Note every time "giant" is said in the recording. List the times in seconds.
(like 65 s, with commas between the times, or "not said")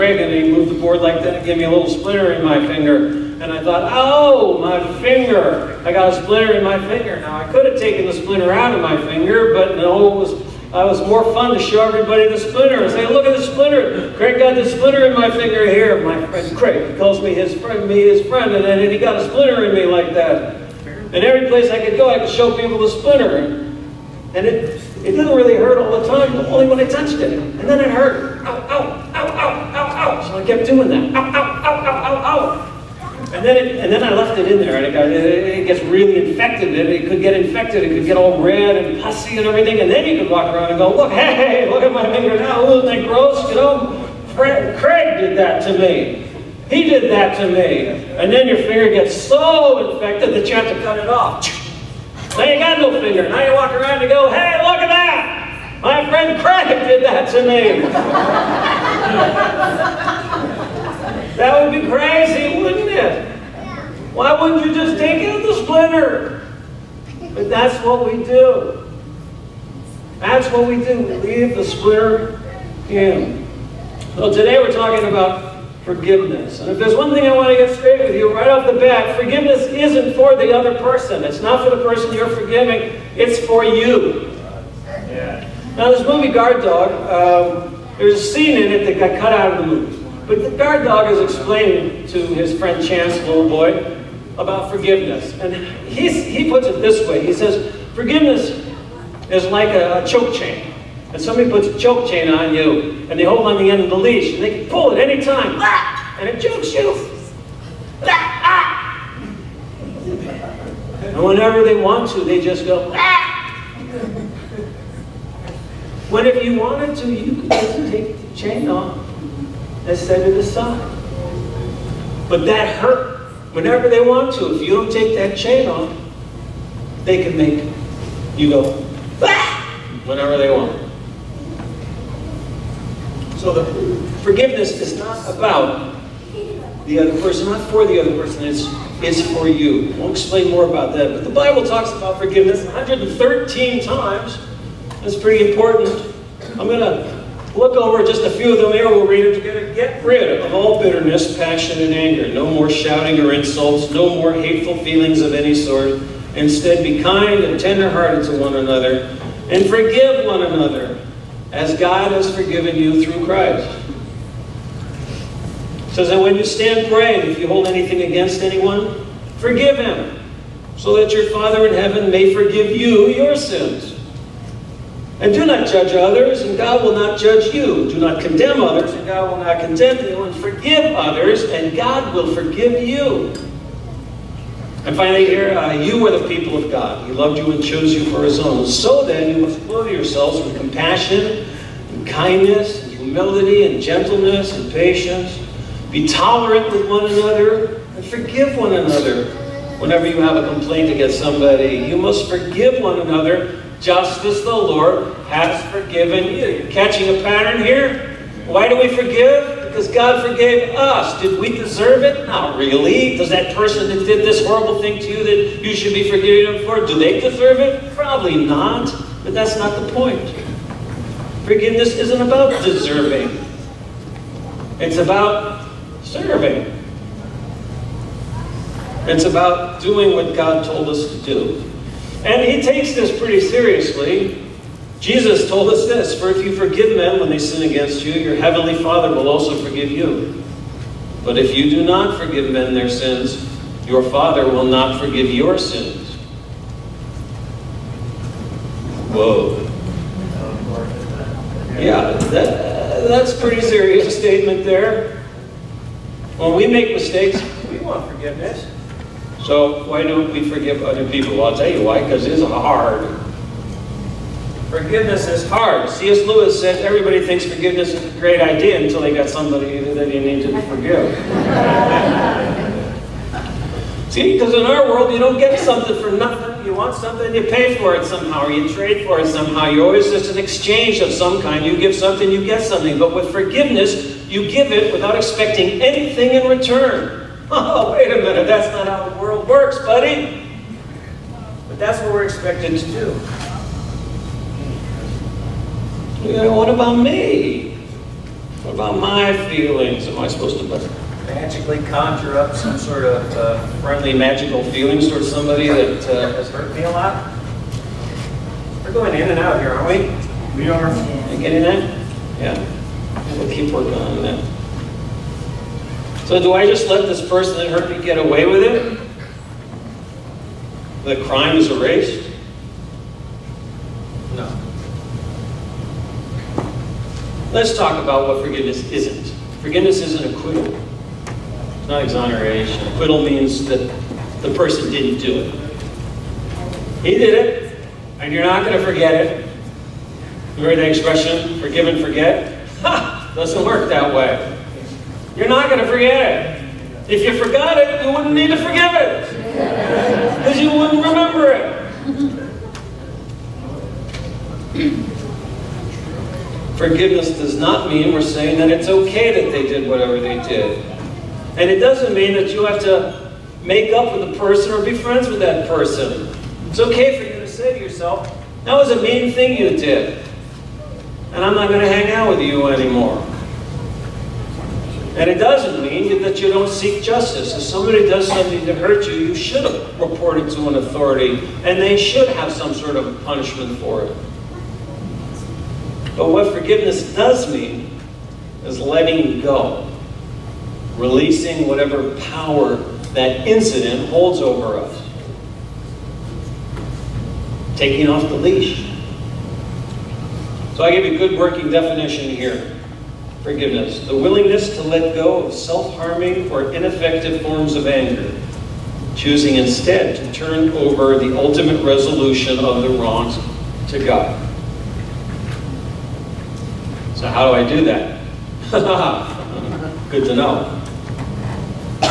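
not said.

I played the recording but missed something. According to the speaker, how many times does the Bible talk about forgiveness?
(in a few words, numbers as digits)
113.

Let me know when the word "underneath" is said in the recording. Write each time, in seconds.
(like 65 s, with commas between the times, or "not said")
not said.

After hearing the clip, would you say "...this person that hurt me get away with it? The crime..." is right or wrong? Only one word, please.
right.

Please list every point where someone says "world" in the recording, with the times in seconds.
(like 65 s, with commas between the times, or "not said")
274 s, 289 s.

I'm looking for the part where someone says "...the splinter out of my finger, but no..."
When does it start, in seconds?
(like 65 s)
8 s.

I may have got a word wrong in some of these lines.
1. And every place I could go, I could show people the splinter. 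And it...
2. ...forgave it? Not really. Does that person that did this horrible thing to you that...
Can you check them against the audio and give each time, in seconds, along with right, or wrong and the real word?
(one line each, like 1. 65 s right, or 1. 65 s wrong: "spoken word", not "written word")
1. 20 s right
2. 211 s wrong: "deserve", not "forgave".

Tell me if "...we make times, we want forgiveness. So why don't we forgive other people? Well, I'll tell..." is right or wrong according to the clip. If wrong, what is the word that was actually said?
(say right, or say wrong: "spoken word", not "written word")
wrong: "mistakes", not "times".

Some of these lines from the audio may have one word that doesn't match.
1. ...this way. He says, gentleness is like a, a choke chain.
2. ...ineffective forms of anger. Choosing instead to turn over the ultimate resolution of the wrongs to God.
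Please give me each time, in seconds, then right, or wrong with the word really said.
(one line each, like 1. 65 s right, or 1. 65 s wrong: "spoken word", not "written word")
1. 96 s wrong: "forgiveness", not "gentleness"
2. 406 s right.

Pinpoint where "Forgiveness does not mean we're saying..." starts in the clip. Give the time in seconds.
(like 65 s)
356 s.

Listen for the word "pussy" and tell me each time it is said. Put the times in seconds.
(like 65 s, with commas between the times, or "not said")
39 s.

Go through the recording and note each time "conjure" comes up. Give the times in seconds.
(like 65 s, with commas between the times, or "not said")
301 s.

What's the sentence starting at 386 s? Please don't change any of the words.
But what forgiveness does mean is letting go releasing whatever power that incident holds over us.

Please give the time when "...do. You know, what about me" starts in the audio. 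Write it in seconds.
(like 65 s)
292 s.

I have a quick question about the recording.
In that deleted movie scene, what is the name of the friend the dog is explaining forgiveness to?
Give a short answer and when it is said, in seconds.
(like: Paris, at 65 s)
Chance, at 92 s.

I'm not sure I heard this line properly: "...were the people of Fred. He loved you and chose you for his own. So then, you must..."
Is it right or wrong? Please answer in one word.
wrong.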